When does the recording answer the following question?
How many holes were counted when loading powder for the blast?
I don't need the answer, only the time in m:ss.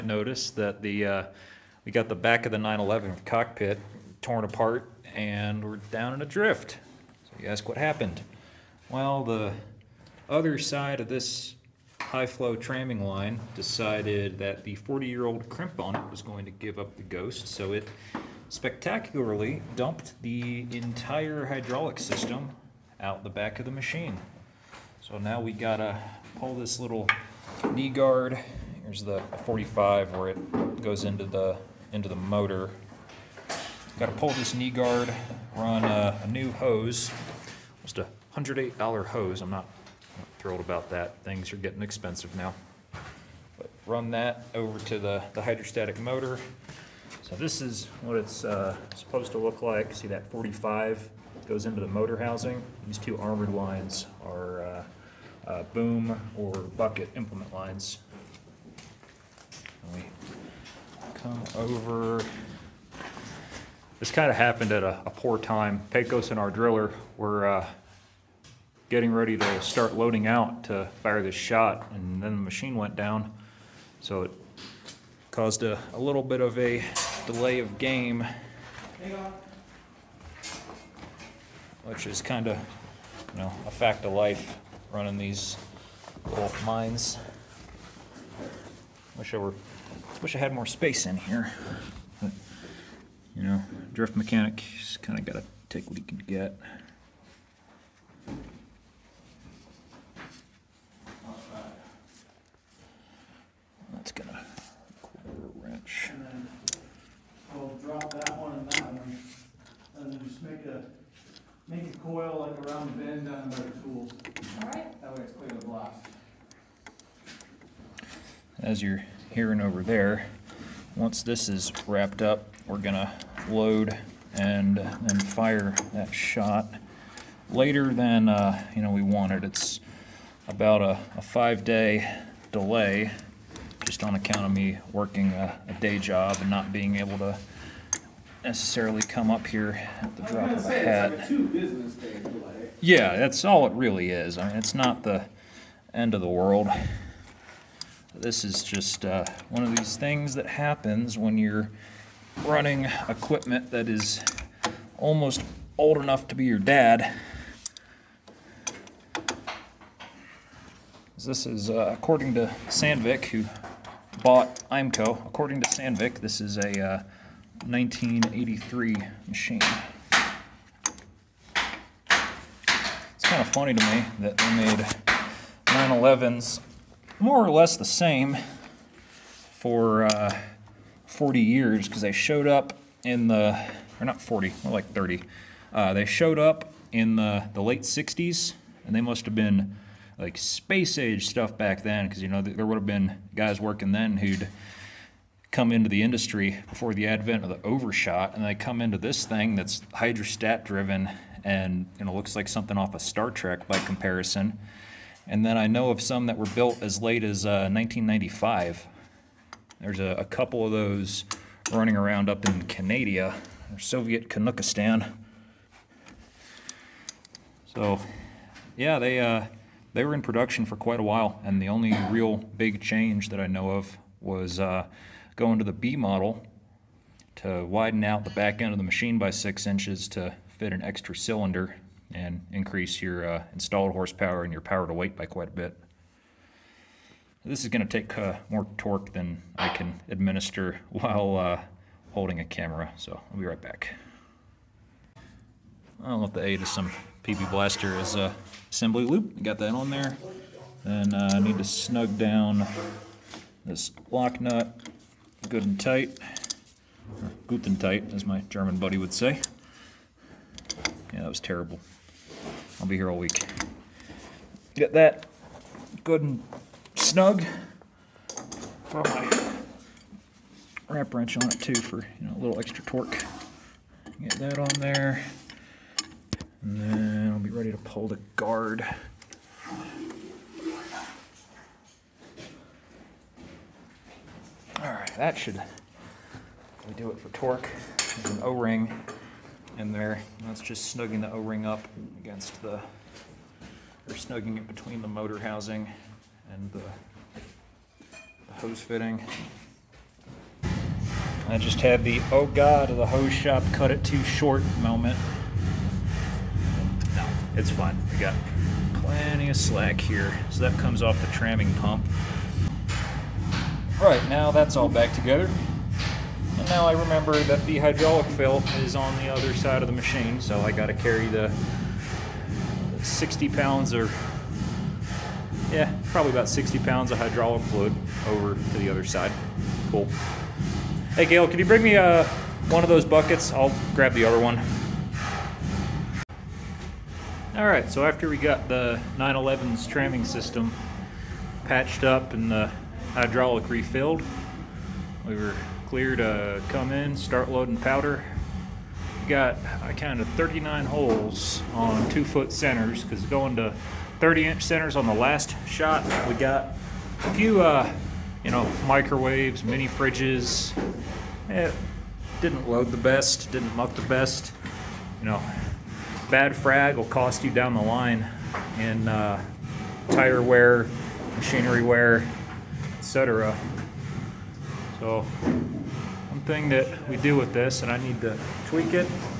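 5:50.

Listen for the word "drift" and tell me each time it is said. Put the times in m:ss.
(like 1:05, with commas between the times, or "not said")
0:06, 1:33.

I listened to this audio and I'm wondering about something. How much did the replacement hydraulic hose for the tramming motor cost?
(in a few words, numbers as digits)
$108.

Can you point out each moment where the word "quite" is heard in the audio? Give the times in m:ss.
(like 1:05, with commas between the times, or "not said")
3:40, 3:55.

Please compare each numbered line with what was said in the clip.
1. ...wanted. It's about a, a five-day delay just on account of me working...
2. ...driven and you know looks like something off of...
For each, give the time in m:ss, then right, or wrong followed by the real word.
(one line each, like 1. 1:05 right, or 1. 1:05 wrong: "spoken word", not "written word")
1. 2:09 right
2. 3:20 right.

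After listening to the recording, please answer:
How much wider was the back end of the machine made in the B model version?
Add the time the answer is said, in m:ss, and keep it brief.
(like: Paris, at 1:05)
six inches, at 3:49.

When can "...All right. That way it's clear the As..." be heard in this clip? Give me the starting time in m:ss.
1:53.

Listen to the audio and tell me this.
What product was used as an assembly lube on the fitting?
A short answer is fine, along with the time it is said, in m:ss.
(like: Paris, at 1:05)
PB Blaster, at 4:07.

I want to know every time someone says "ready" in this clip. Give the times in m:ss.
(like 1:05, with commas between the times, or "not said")
1:09, 4:37.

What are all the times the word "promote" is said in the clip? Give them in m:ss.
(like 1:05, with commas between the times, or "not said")
not said.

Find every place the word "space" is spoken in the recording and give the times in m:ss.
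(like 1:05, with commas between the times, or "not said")
1:30, 3:10.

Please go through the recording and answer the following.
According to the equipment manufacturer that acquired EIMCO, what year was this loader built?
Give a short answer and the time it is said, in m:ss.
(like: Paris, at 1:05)
1983, at 2:47.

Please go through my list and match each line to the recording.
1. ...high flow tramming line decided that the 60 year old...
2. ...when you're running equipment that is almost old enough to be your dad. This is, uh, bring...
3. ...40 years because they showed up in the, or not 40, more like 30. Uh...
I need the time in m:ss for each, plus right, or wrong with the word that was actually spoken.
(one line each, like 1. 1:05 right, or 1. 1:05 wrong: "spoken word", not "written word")
1. 0:12 wrong: "40", not "60"
2. 2:31 wrong: "according", not "bring"
3. 3:01 right.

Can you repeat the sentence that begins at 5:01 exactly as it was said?
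I just had the, oh God, the hose shop cut it too short moment.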